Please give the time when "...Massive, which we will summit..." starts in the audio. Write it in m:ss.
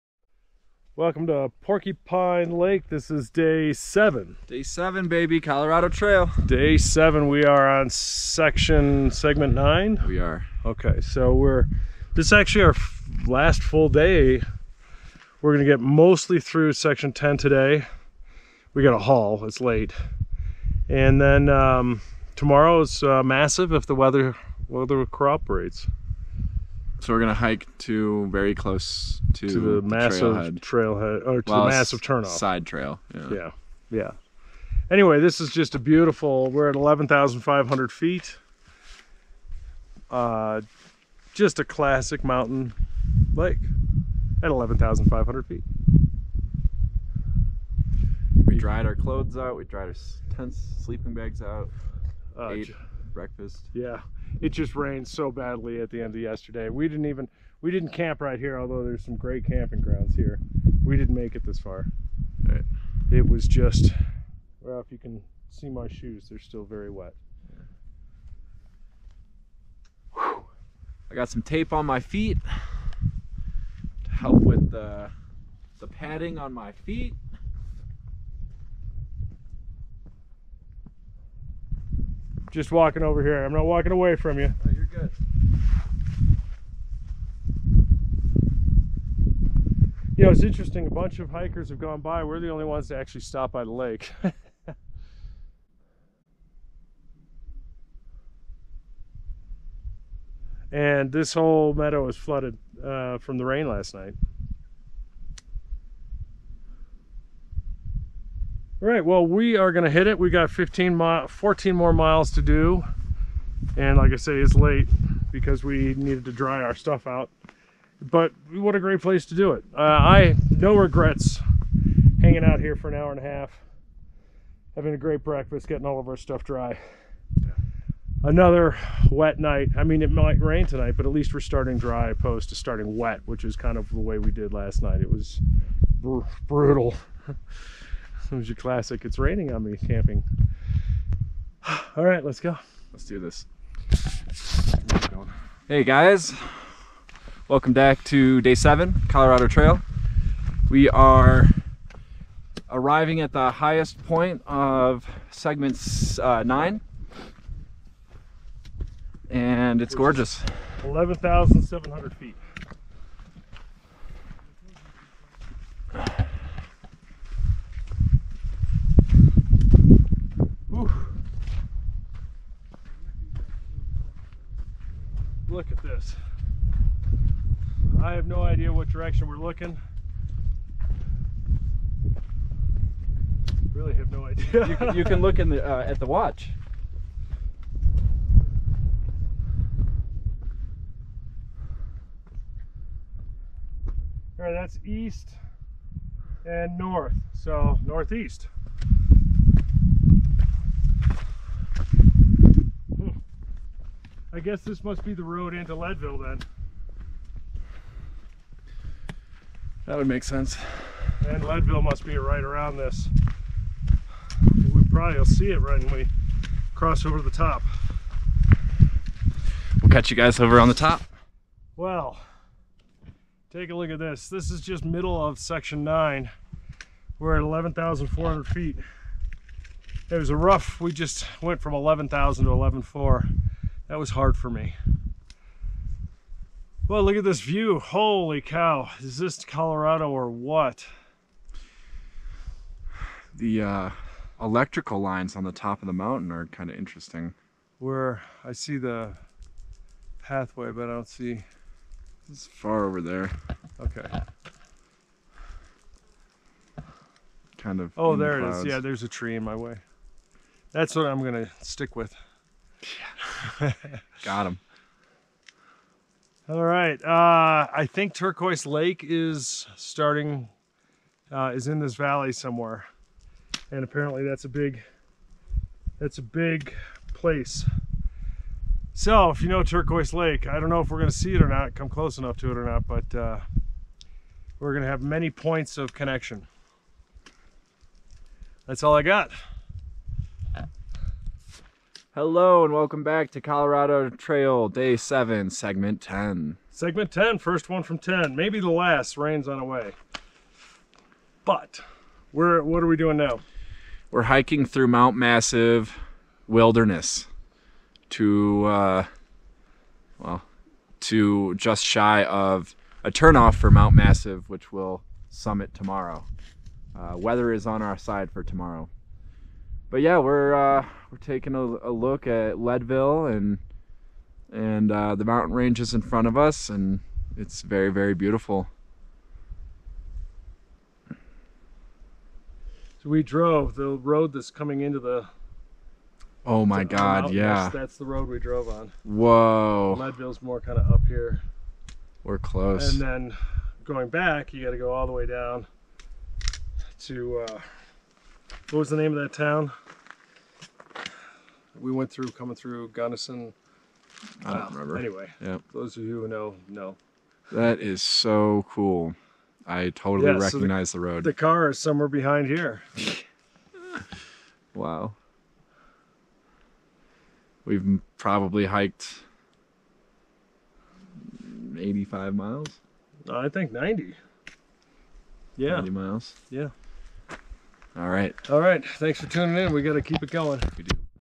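5:13.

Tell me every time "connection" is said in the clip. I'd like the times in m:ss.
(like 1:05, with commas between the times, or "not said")
4:45.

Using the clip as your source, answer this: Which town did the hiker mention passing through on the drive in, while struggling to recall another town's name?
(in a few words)
Gunnison.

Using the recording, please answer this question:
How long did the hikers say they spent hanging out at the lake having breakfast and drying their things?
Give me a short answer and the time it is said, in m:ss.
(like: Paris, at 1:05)
an hour and a half, at 2:02.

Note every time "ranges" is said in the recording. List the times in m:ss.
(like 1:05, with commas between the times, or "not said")
5:25.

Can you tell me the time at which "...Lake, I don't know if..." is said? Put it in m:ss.
4:40.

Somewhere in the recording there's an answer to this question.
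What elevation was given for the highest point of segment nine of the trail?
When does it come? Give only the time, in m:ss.
2:40.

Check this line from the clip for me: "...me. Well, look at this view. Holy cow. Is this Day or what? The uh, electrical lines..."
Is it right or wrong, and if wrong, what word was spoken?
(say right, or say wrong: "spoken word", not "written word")
wrong: "Colorado", not "Day".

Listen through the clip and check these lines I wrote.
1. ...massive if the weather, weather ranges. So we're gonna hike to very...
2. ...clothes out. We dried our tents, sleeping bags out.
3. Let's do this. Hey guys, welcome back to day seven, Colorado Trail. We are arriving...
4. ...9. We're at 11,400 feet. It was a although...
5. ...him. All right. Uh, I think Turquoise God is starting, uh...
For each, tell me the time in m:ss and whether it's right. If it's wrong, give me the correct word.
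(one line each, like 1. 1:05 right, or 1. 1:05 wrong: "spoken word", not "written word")
1. 0:23 wrong: "cooperates", not "ranges"
2. 0:48 right
3. 2:22 right
4. 3:45 wrong: "rough", not "although"
5. 4:24 wrong: "Lake", not "God".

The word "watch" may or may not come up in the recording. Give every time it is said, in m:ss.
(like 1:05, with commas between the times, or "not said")
3:06.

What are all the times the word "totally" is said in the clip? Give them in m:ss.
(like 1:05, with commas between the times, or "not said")
5:59.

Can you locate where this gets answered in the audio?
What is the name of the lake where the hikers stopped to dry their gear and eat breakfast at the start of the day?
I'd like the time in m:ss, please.
0:01.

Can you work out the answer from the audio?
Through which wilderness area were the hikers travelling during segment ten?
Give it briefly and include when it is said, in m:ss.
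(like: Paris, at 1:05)
Mount Massive Wilderness, at 5:04.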